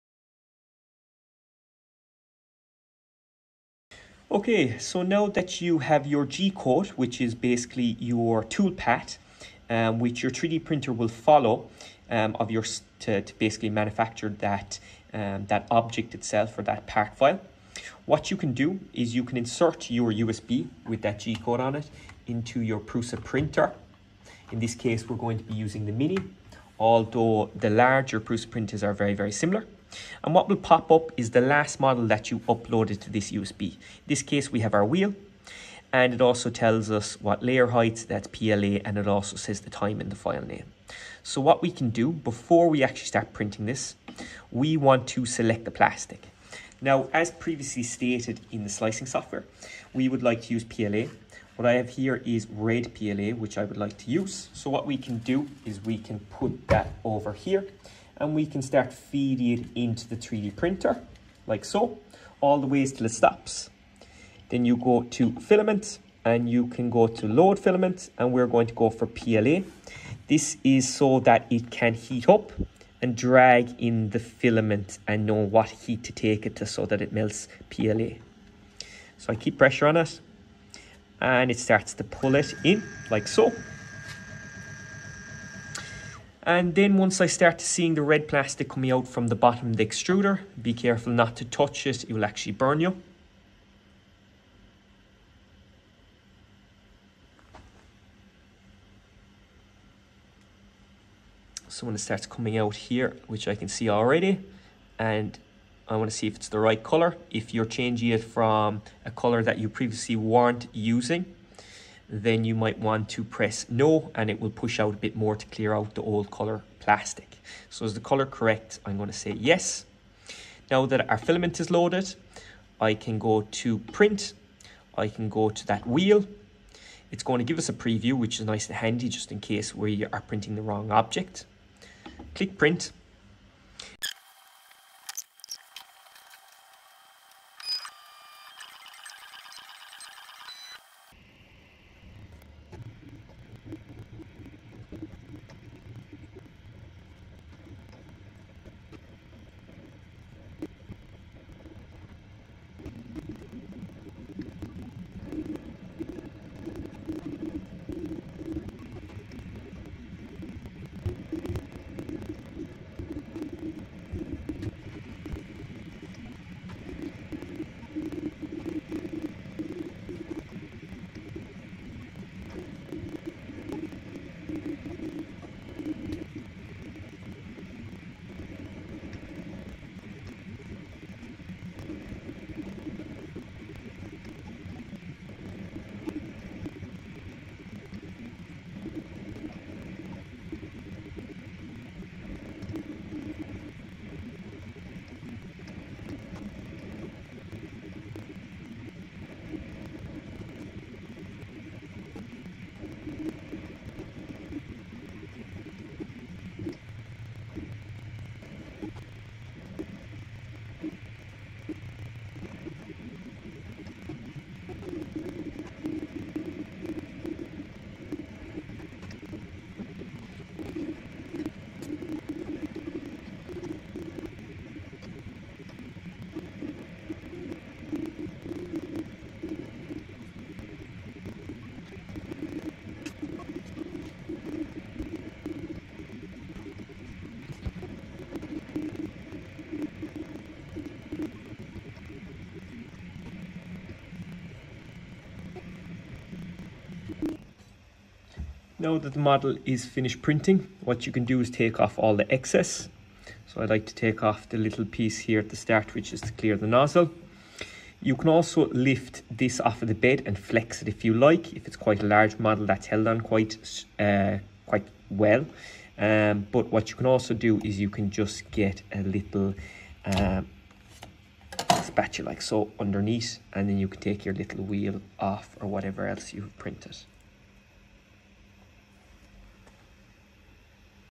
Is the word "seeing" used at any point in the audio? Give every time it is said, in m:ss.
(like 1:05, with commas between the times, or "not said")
1:27.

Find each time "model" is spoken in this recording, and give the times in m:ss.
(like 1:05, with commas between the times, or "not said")
0:31, 4:09, 4:22.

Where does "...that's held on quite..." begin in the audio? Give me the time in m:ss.
4:22.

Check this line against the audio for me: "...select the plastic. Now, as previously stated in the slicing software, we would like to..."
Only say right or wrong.
right.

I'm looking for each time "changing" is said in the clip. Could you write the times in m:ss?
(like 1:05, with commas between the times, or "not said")
1:47.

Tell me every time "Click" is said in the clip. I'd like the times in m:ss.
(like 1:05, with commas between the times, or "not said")
2:12.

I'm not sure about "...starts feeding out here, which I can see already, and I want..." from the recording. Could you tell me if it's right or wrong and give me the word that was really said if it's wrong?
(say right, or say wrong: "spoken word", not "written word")
wrong: "coming", not "feeding".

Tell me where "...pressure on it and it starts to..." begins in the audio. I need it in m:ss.
1:19.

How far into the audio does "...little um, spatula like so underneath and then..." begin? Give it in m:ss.
4:29.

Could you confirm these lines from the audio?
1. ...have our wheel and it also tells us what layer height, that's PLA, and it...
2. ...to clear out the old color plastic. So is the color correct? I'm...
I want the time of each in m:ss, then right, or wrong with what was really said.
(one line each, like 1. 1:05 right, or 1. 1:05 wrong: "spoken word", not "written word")
1. 0:34 right
2. 1:55 right.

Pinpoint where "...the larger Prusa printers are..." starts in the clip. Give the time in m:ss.
0:27.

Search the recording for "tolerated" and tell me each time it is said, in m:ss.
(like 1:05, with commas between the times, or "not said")
not said.